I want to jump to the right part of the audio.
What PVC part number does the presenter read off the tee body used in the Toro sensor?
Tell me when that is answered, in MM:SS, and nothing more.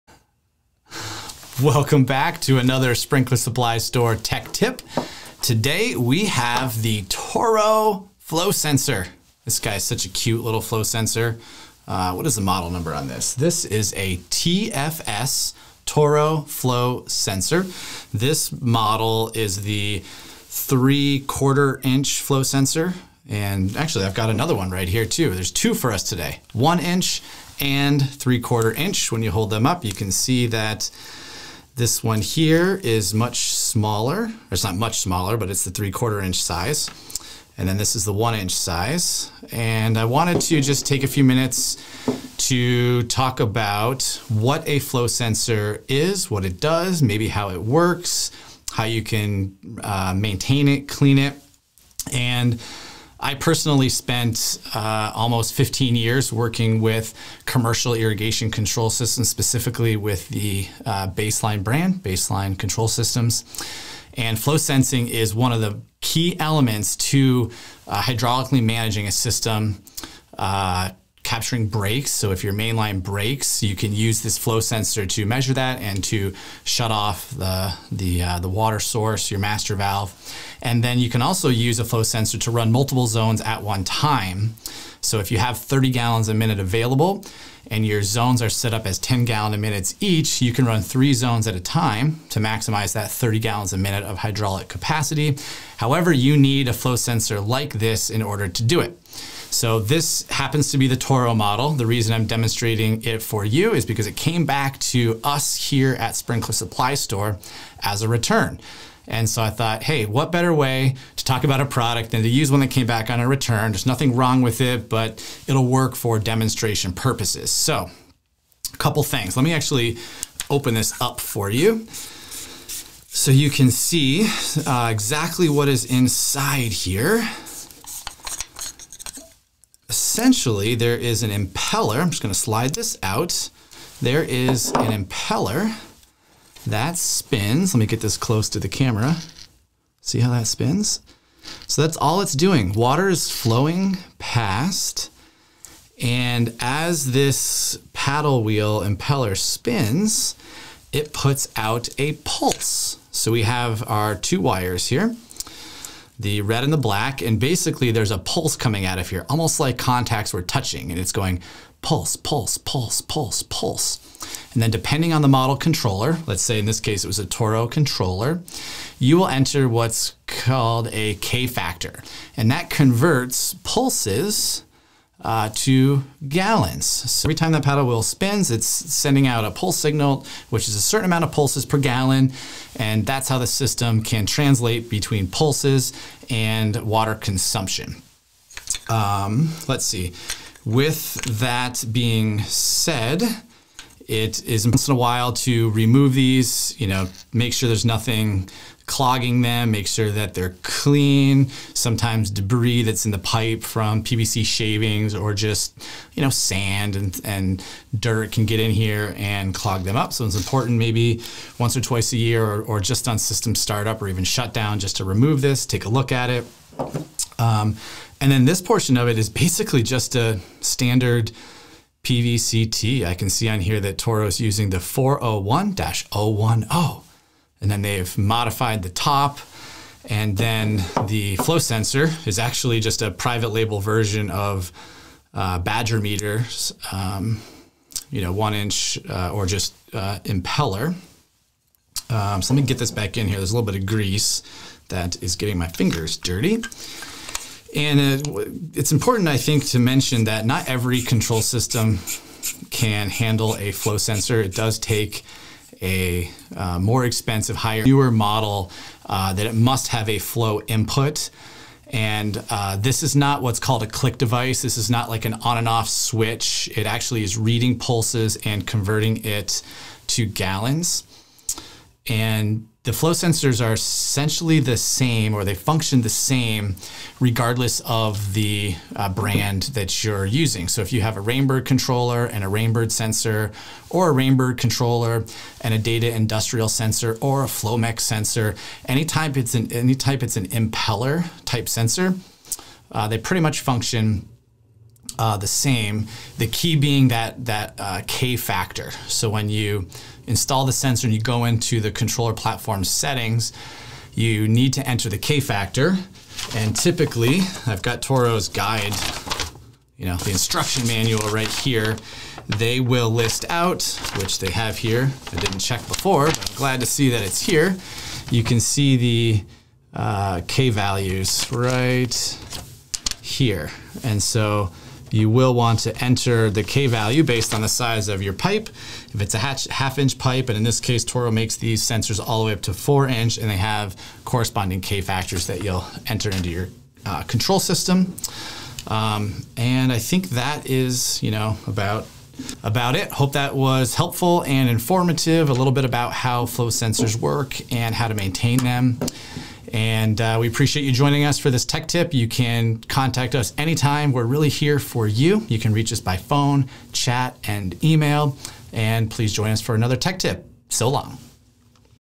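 03:44.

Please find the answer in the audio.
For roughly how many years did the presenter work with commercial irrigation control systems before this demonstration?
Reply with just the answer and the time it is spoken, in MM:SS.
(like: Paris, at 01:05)
15 years, at 00:55.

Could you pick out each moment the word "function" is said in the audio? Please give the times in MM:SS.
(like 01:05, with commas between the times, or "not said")
04:35, 04:53.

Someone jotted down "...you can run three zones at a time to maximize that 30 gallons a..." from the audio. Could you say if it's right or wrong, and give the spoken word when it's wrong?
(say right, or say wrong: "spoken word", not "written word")
right.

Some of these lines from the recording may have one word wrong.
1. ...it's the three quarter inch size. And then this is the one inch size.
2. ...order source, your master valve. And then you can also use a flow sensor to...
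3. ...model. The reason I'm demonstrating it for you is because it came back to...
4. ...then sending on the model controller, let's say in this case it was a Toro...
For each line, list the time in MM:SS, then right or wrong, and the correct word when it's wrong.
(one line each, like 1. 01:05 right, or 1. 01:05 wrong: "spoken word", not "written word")
1. 00:35 right
2. 01:18 wrong: "water", not "order"
3. 01:41 right
4. 02:44 wrong: "depending", not "sending".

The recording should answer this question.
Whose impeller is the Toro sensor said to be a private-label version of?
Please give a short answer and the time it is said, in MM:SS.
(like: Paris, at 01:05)
Badger meters, at 03:55.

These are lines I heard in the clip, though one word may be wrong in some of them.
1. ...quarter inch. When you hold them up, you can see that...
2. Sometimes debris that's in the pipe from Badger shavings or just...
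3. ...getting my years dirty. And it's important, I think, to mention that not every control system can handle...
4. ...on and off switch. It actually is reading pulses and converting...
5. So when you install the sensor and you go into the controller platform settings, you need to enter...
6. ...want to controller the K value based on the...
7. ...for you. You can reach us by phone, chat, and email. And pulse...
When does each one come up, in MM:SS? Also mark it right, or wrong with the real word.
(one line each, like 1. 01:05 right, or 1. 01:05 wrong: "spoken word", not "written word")
1. 00:28 right
2. 03:21 wrong: "PVC", not "Badger"
3. 04:05 wrong: "fingers", not "years"
4. 04:25 right
5. 04:59 right
6. 05:25 wrong: "enter", not "controller"
7. 05:54 wrong: "please", not "pulse".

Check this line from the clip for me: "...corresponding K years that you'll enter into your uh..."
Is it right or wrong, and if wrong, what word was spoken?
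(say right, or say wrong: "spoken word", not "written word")
wrong: "factors", not "years".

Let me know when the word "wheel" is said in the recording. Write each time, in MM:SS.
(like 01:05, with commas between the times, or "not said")
02:28, 02:57.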